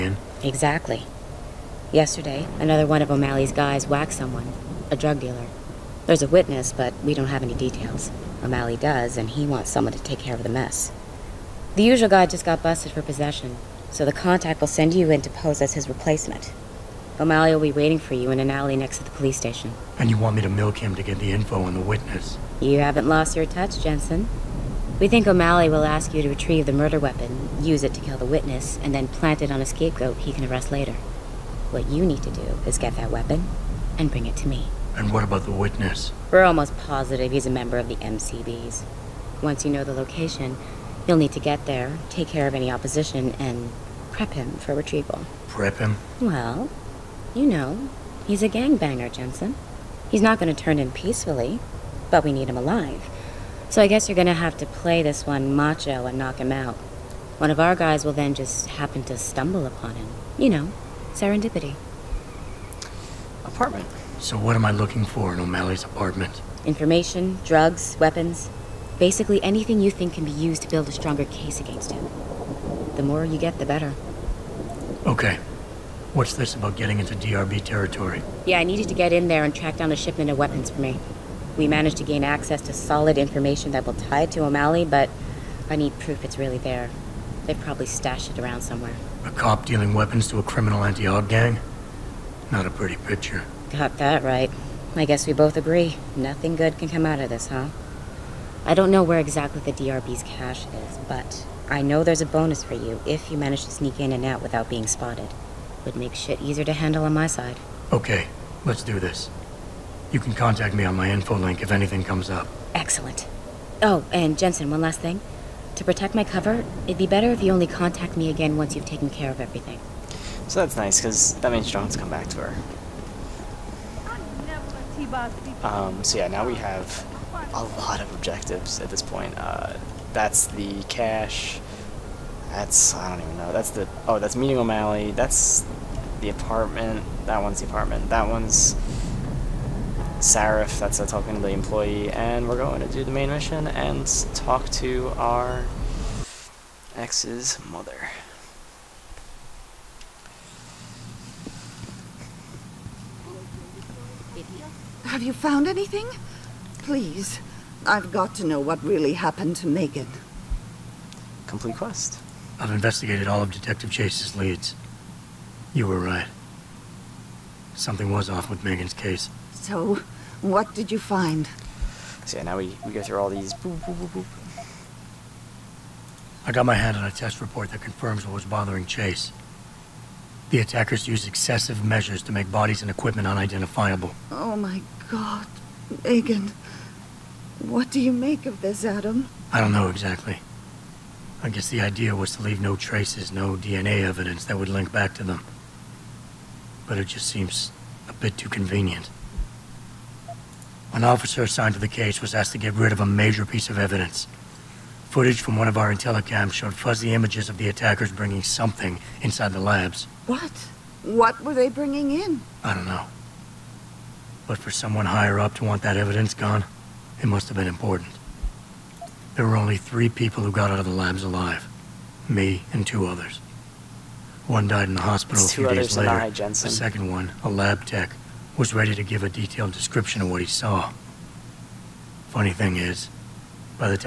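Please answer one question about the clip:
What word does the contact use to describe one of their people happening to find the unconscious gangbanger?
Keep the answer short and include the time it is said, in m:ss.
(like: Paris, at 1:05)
Serendipity, at 1:01.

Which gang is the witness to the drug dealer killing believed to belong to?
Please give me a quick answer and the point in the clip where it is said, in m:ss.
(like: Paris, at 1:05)
The MCBs, at 0:37.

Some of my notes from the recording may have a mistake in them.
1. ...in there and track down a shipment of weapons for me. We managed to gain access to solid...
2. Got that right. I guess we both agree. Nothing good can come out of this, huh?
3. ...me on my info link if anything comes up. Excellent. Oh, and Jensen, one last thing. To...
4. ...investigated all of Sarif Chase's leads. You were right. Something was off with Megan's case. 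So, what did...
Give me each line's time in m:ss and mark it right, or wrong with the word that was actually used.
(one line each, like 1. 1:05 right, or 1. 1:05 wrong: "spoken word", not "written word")
1. 1:19 right
2. 1:33 right
3. 1:50 right
4. 2:42 wrong: "Detective", not "Sarif".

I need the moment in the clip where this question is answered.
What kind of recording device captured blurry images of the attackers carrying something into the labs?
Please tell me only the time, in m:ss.
3:25.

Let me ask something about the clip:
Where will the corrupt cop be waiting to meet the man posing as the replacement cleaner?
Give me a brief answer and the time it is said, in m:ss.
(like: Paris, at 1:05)
In an alley next to the police station, at 0:18.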